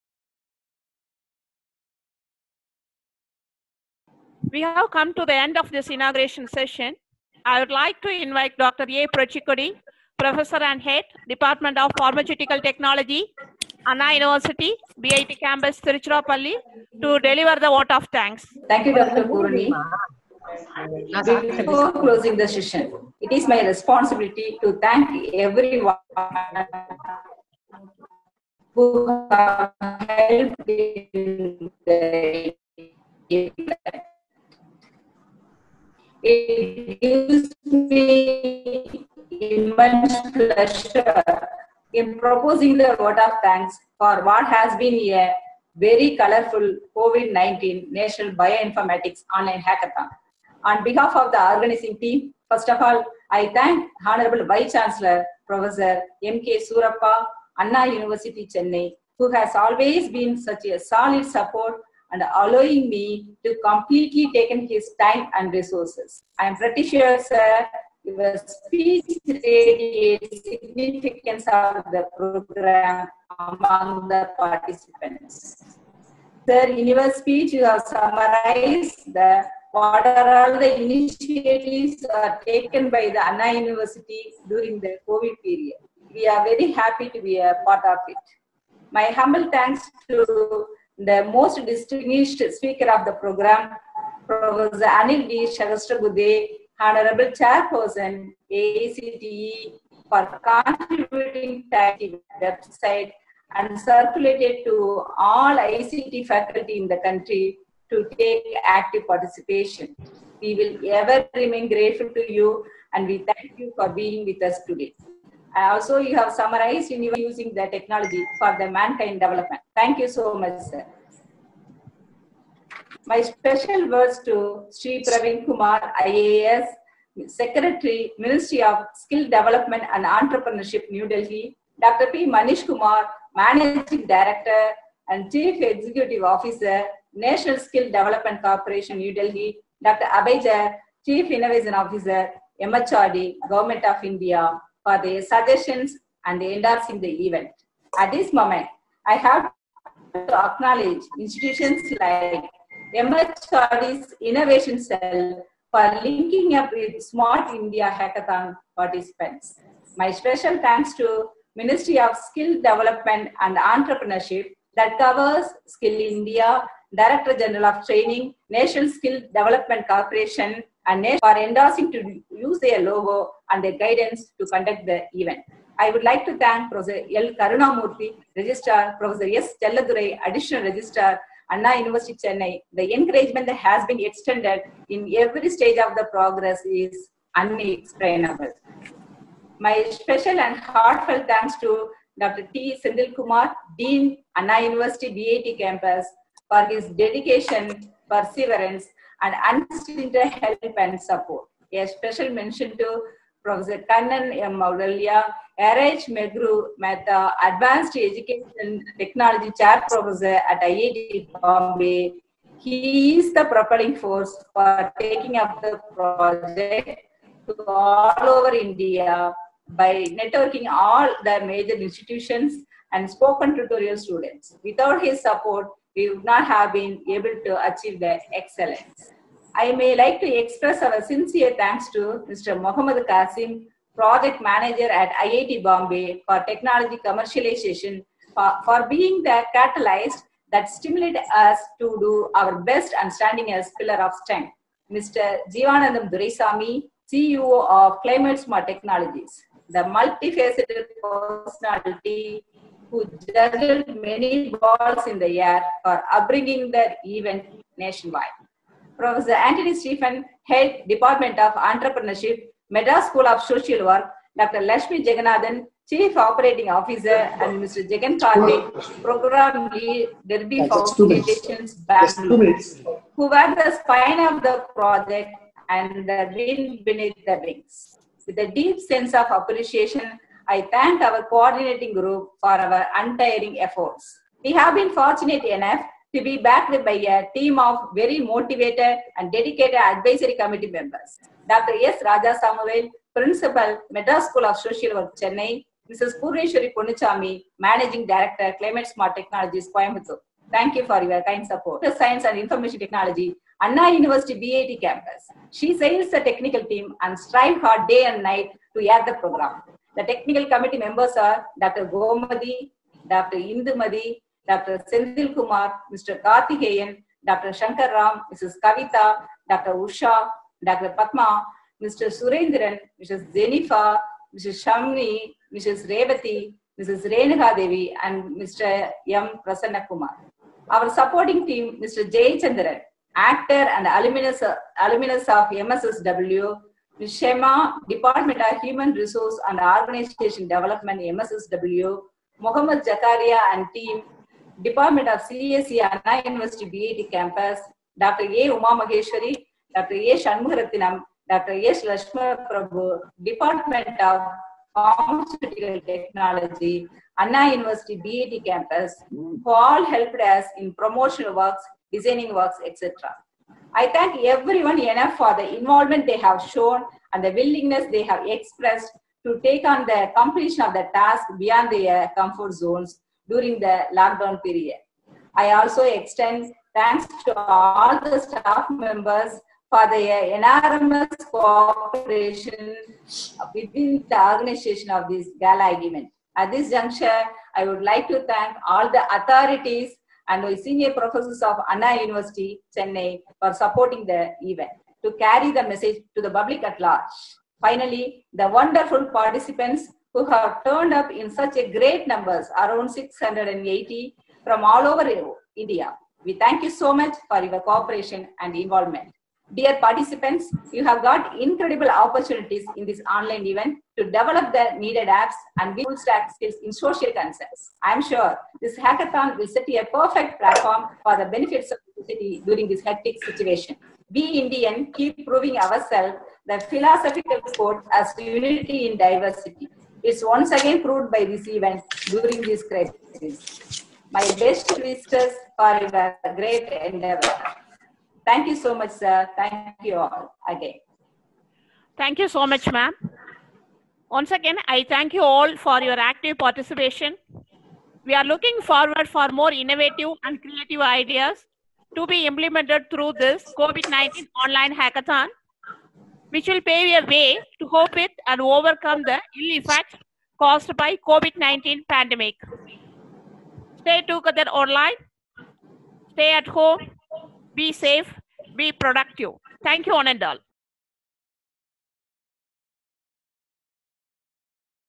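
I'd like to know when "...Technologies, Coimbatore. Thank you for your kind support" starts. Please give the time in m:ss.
4:59.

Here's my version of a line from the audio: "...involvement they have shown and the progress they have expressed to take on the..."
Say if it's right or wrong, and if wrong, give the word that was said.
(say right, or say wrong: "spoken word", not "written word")
wrong: "willingness", not "progress".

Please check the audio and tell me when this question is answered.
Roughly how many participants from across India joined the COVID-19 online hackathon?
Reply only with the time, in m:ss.
6:42.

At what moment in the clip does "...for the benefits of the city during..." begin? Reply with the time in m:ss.
7:01.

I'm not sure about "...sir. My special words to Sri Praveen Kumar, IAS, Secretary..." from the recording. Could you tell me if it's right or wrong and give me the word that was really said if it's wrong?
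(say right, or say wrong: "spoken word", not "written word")
right.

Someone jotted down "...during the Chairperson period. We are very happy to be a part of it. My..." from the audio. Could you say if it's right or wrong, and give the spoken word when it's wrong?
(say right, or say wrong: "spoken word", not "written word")
wrong: "COVID", not "Chairperson".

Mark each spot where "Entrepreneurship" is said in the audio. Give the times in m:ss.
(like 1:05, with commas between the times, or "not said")
2:10, 2:43, 4:21.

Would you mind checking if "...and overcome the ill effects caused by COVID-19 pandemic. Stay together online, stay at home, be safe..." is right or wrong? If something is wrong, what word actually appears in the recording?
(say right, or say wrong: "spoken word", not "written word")
right.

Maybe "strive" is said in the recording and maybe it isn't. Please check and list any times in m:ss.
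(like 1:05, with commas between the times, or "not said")
5:07.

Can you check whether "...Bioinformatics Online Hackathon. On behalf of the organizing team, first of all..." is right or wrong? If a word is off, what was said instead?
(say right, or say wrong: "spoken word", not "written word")
right.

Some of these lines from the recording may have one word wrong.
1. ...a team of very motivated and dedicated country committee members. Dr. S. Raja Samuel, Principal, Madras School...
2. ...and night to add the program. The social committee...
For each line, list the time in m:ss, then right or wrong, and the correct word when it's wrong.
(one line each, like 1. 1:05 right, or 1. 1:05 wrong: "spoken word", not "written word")
1. 4:47 wrong: "advisory", not "country"
2. 5:08 wrong: "technical", not "social".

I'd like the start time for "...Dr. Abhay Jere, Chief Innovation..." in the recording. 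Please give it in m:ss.
2:19.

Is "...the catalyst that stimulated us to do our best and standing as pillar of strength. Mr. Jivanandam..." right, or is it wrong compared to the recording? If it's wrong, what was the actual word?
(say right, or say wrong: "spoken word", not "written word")
right.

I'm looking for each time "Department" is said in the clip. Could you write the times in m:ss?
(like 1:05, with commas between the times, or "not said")
0:11, 4:20, 5:37, 5:44, 5:53.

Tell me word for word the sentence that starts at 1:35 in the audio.
Shagastha Honorable Chairperson, AICTE for contributing to the website and circulated to all ICT faculty in the country to take active participation.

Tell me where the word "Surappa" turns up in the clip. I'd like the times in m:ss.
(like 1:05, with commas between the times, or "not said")
0:56.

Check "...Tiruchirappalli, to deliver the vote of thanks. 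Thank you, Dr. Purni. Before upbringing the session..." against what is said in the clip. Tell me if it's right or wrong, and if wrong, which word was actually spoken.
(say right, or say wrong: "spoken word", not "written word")
wrong: "closing", not "upbringing".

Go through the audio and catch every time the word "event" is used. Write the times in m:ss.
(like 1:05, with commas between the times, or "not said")
2:27, 2:55, 4:17, 6:25, 6:34, 6:53, 7:11.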